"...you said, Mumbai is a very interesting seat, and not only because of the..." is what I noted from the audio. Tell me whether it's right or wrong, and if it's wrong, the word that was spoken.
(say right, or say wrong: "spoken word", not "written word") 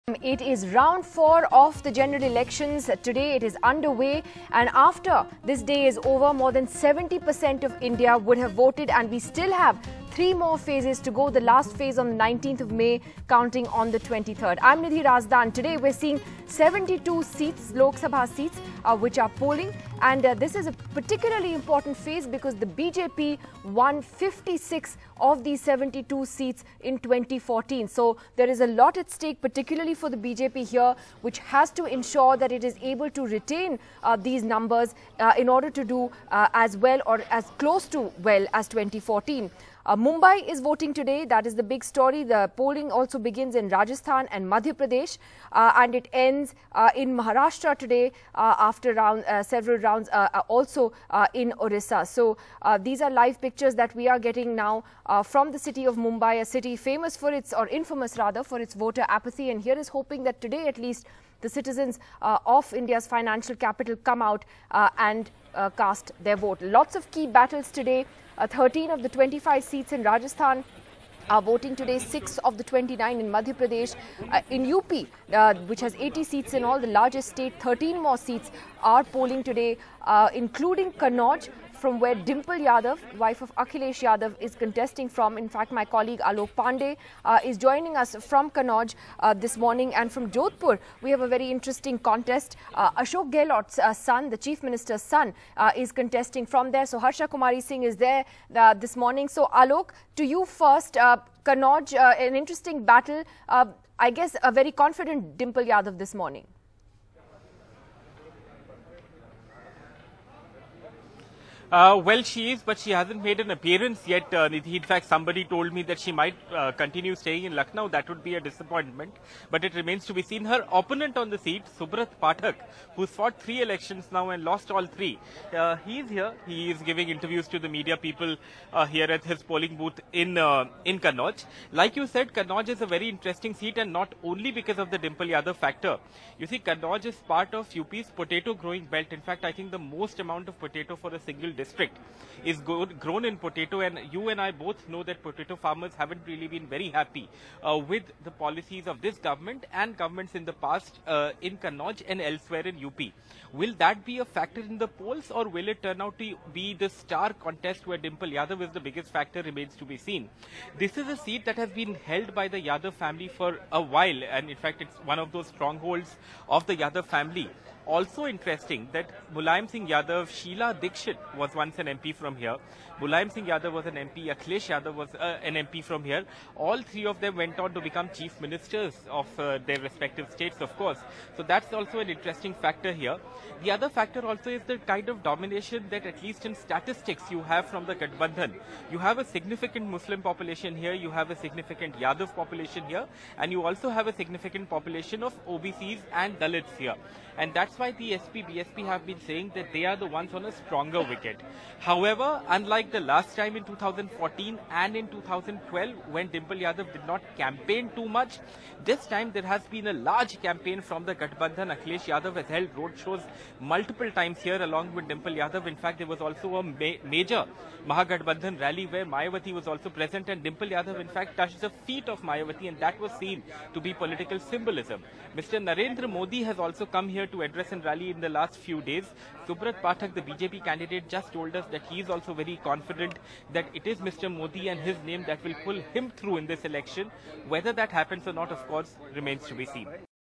wrong: "Kannauj", not "Mumbai".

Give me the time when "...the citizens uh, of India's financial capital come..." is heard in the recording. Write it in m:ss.
1:01.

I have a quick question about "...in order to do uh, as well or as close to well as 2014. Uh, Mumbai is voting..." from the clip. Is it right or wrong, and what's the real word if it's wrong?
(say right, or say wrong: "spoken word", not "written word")
right.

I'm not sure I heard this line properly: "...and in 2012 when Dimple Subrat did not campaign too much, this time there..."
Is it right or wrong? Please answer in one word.
wrong.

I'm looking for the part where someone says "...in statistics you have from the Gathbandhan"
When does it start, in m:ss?
3:06.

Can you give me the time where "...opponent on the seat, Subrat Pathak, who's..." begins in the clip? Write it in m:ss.
2:00.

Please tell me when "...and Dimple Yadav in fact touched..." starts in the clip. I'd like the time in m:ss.
3:40.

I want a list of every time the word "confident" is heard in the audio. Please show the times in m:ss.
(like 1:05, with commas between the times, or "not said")
1:44, 3:52.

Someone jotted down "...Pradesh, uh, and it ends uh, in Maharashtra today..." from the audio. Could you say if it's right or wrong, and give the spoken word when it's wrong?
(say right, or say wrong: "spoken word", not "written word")
right.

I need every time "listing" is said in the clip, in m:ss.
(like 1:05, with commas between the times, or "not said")
not said.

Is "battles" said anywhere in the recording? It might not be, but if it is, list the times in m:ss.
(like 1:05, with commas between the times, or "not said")
1:07, 1:42.